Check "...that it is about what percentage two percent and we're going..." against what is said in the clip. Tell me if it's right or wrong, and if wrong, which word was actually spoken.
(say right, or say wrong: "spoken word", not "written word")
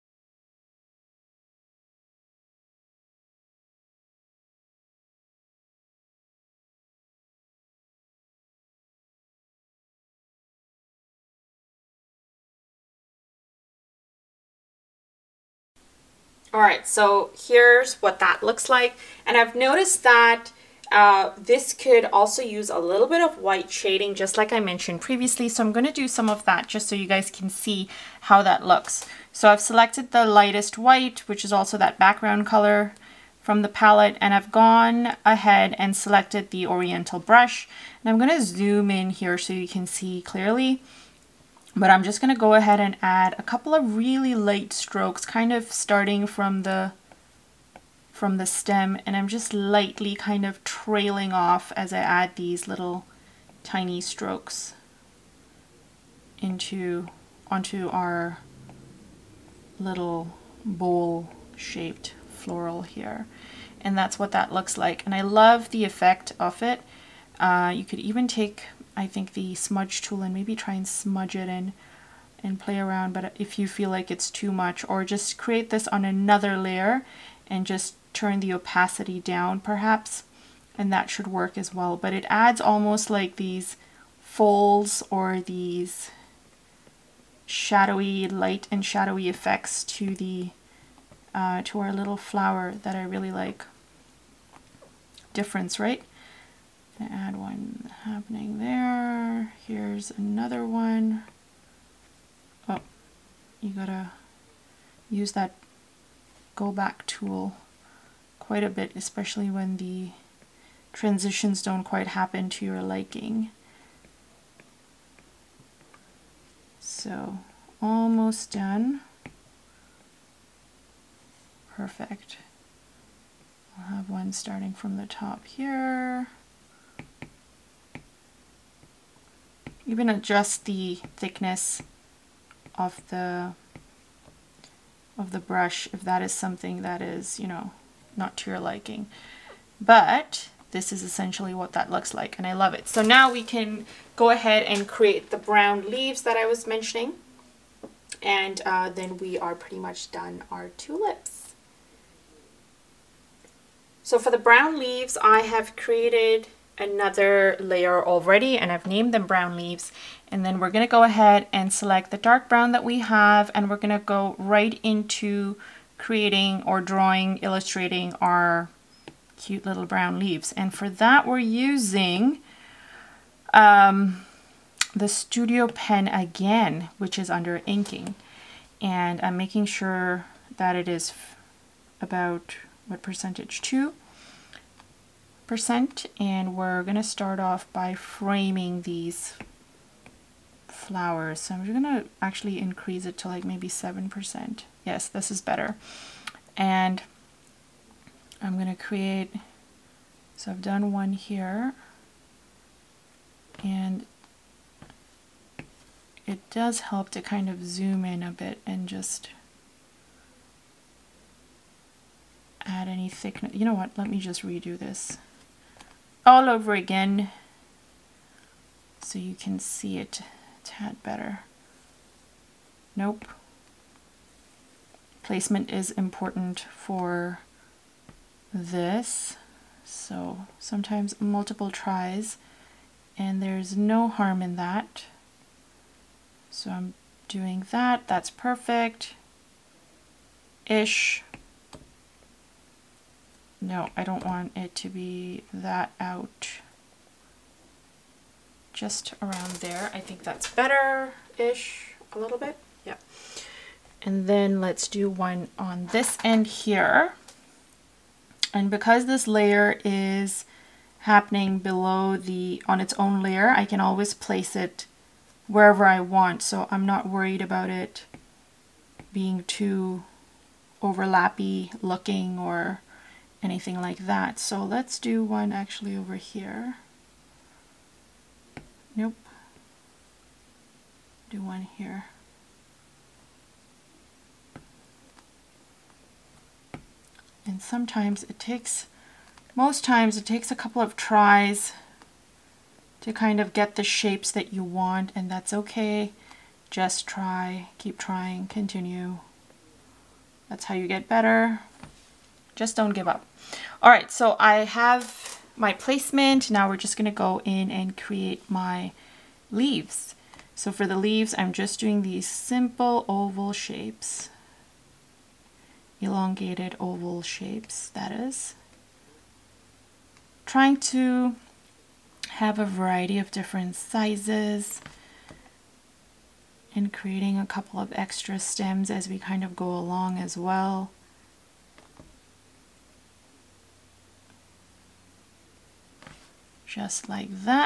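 right.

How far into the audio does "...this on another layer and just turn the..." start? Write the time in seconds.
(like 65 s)
75 s.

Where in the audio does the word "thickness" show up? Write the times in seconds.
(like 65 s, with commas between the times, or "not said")
131 s, 213 s.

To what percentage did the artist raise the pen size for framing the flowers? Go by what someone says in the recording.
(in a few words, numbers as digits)
7%.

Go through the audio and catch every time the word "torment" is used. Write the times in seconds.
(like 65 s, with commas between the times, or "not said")
not said.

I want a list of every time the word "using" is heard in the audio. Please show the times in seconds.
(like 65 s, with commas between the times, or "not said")
171 s.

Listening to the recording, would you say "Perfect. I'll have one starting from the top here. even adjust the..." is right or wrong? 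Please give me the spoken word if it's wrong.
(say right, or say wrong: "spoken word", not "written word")
right.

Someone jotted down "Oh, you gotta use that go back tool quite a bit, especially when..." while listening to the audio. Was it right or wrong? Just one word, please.
right.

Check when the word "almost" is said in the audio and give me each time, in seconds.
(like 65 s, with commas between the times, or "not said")
82 s, 117 s.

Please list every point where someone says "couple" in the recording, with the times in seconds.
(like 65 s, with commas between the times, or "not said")
43 s, 290 s, 327 s.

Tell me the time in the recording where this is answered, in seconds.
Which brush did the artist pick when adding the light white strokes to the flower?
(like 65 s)
36 s.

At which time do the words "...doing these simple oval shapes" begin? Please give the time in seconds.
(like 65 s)
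311 s.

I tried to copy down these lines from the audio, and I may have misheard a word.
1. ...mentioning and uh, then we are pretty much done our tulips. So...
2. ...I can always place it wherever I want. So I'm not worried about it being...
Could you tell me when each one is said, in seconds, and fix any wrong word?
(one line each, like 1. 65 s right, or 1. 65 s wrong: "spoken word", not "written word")
1. 146 s right
2. 263 s right.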